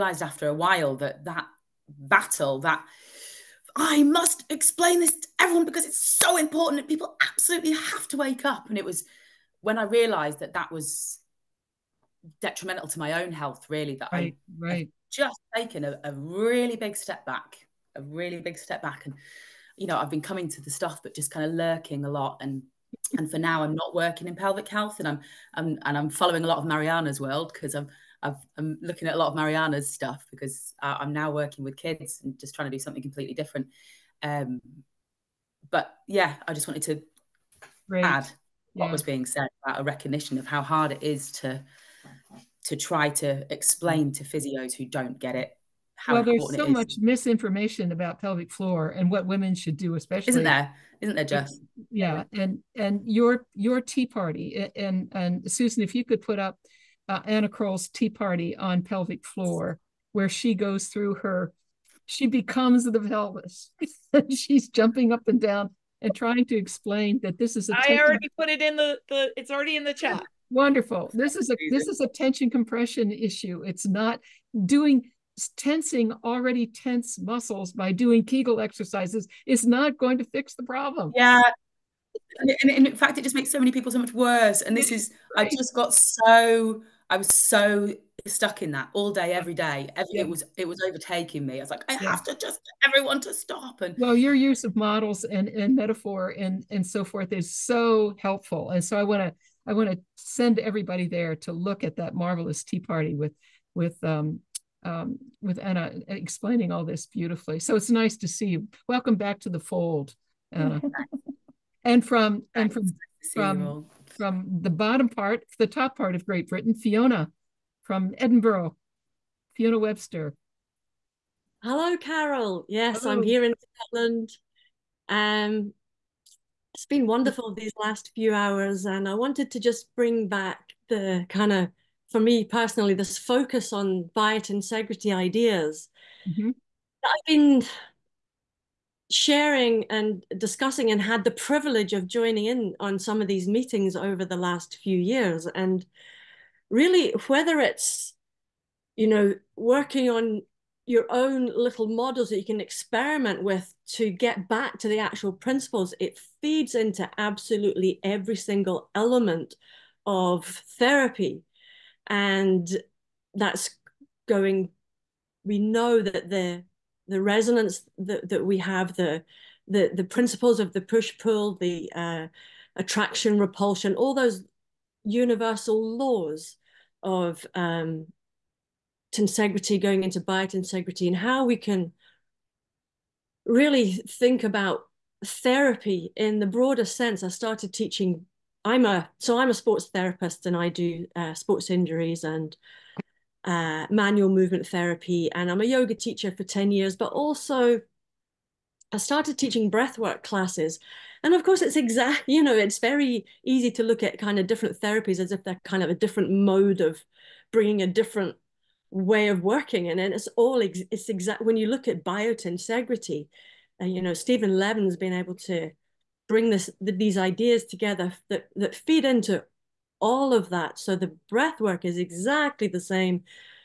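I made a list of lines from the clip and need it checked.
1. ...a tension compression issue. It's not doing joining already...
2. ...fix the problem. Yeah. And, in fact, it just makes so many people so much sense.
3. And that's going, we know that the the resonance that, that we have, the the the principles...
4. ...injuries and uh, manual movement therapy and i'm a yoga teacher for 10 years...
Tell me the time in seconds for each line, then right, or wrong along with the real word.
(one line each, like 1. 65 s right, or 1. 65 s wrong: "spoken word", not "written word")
1. 72 s wrong: "tensing", not "joining"
2. 80 s wrong: "worse", not "sense"
3. 162 s right
4. 191 s right.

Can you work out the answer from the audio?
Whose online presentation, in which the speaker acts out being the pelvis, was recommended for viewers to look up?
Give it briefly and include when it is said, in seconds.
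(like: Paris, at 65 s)
Anna Kroll, at 57 s.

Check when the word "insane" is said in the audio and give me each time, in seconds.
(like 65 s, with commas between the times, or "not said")
not said.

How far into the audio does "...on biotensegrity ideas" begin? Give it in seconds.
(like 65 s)
133 s.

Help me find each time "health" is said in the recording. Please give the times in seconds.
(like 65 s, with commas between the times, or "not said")
13 s, 24 s.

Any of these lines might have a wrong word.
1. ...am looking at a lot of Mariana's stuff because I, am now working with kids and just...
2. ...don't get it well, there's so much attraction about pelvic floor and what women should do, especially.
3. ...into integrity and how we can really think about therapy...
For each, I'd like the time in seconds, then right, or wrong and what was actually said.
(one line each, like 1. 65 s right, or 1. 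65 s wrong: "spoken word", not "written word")
1. 28 s right
2. 44 s wrong: "misinformation", not "attraction"
3. 180 s wrong: "biotensegrity", not "integrity".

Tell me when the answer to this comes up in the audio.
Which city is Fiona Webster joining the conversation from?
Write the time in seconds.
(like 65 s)
118 s.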